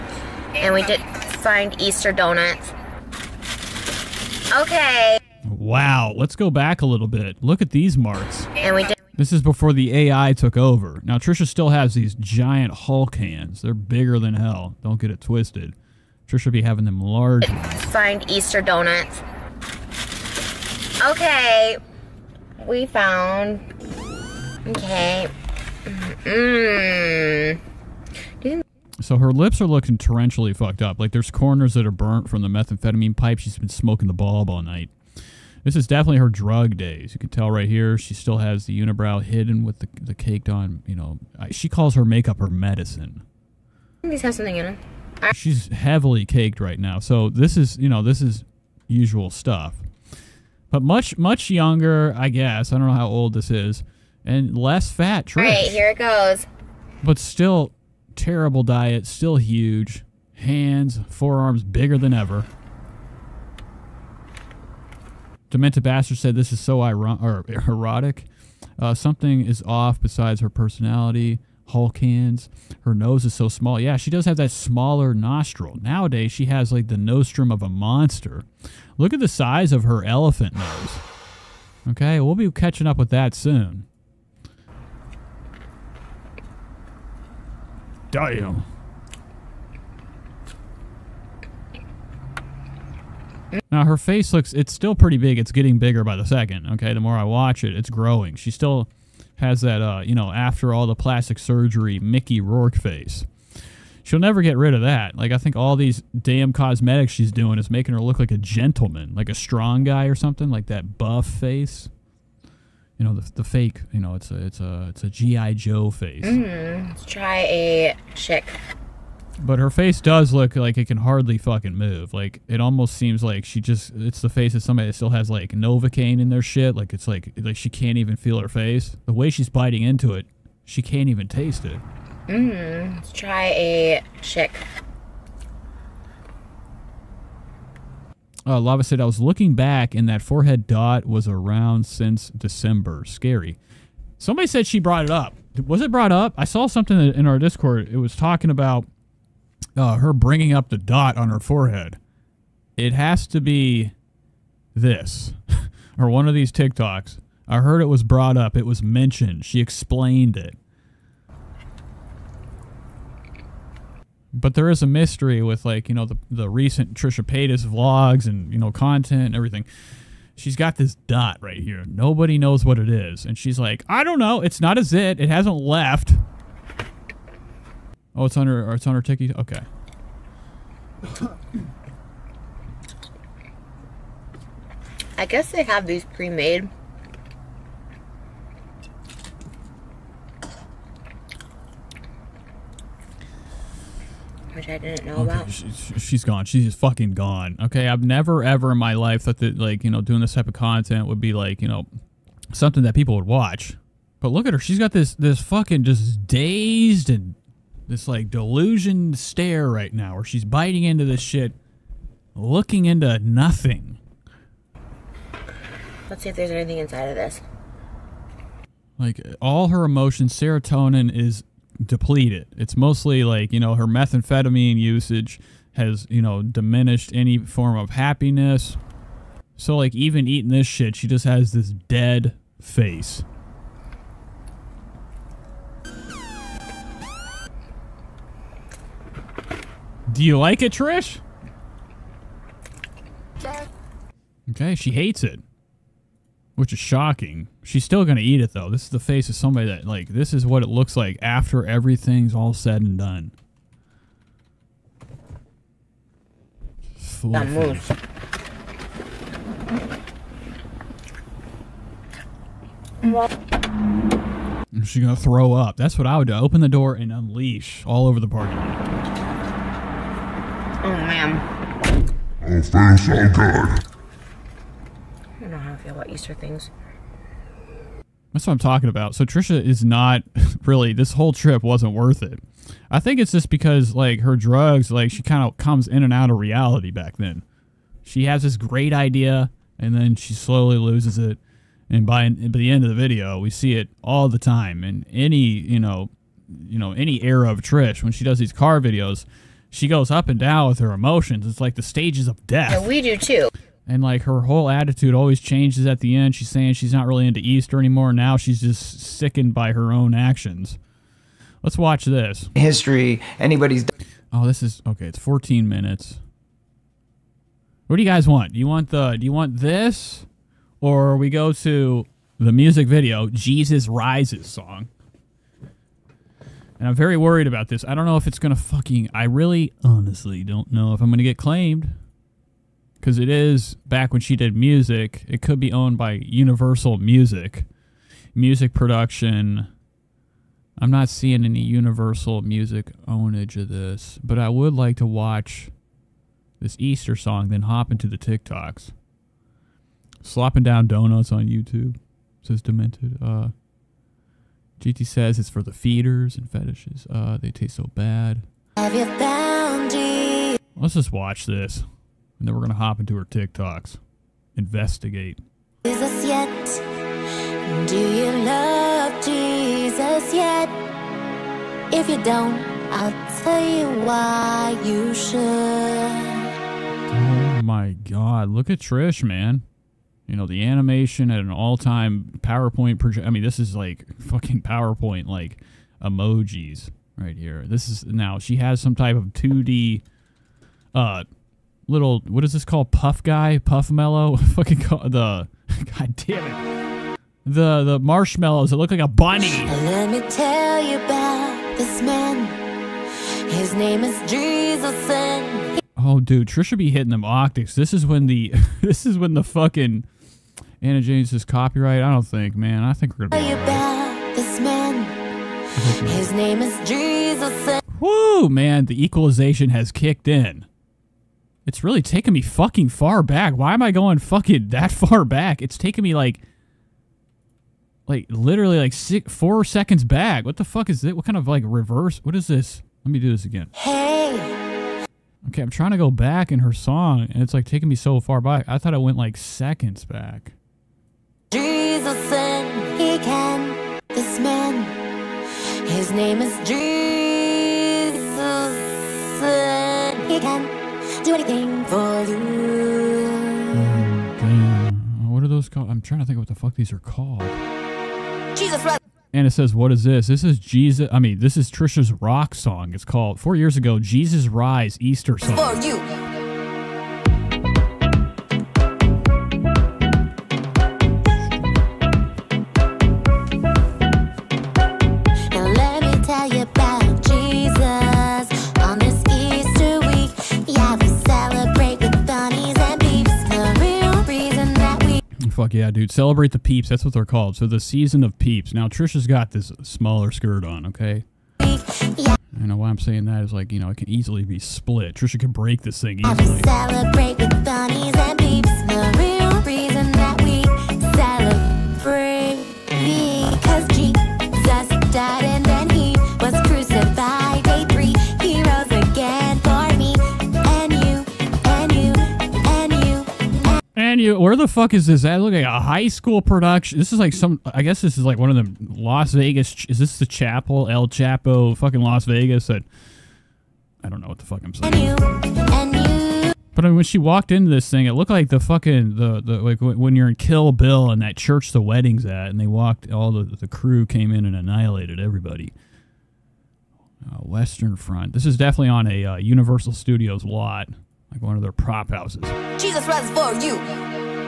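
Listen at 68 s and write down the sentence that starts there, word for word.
Uh, something is off besides her personality hands.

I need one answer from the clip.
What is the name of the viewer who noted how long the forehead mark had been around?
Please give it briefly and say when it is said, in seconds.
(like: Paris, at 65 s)
Lava, at 138 s.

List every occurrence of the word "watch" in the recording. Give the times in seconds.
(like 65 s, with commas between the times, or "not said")
97 s, 203 s, 311 s, 345 s, 361 s.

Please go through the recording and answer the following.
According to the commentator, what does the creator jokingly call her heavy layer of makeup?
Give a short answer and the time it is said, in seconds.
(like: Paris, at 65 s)
her medicine, at 42 s.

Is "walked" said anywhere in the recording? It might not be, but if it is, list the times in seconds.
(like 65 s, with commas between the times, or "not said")
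527 s, 532 s.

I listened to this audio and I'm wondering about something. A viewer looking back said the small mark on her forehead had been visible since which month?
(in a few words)
December.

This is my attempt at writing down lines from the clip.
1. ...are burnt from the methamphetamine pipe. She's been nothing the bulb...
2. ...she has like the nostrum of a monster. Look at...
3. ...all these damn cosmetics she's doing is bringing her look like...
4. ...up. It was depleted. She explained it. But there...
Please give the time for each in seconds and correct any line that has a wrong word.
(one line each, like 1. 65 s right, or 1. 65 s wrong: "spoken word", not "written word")
1. 31 s wrong: "smoking", not "nothing"
2. 76 s right
3. 105 s wrong: "making", not "bringing"
4. 158 s wrong: "mentioned", not "depleted".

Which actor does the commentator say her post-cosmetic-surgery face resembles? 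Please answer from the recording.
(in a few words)
Mickey Rourke.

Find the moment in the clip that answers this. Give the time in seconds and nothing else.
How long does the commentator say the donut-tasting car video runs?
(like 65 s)
315 s.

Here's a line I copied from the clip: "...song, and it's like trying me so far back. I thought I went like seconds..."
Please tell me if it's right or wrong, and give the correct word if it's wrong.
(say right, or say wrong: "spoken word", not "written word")
wrong: "taking", not "trying".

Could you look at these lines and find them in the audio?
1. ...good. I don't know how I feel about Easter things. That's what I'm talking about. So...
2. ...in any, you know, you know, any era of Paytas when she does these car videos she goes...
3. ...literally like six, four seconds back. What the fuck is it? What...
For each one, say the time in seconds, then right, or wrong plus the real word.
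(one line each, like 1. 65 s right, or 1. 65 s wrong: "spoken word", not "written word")
1. 273 s right
2. 294 s wrong: "Trish", not "Paytas"
3. 428 s right.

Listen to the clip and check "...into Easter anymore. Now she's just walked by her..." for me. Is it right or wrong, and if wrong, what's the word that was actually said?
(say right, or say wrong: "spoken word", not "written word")
wrong: "sickened", not "walked".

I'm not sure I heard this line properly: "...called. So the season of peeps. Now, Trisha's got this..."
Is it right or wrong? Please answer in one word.
right.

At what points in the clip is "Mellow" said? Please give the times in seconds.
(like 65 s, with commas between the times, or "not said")
393 s.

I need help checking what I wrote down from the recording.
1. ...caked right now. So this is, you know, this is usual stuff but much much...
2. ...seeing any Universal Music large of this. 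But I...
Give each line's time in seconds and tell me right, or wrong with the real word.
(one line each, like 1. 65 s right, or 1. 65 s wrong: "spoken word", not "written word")
1. 46 s right
2. 341 s wrong: "ownage", not "large".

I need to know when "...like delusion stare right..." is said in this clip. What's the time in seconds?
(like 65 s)
208 s.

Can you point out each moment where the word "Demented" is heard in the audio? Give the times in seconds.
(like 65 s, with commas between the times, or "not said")
65 s, 352 s.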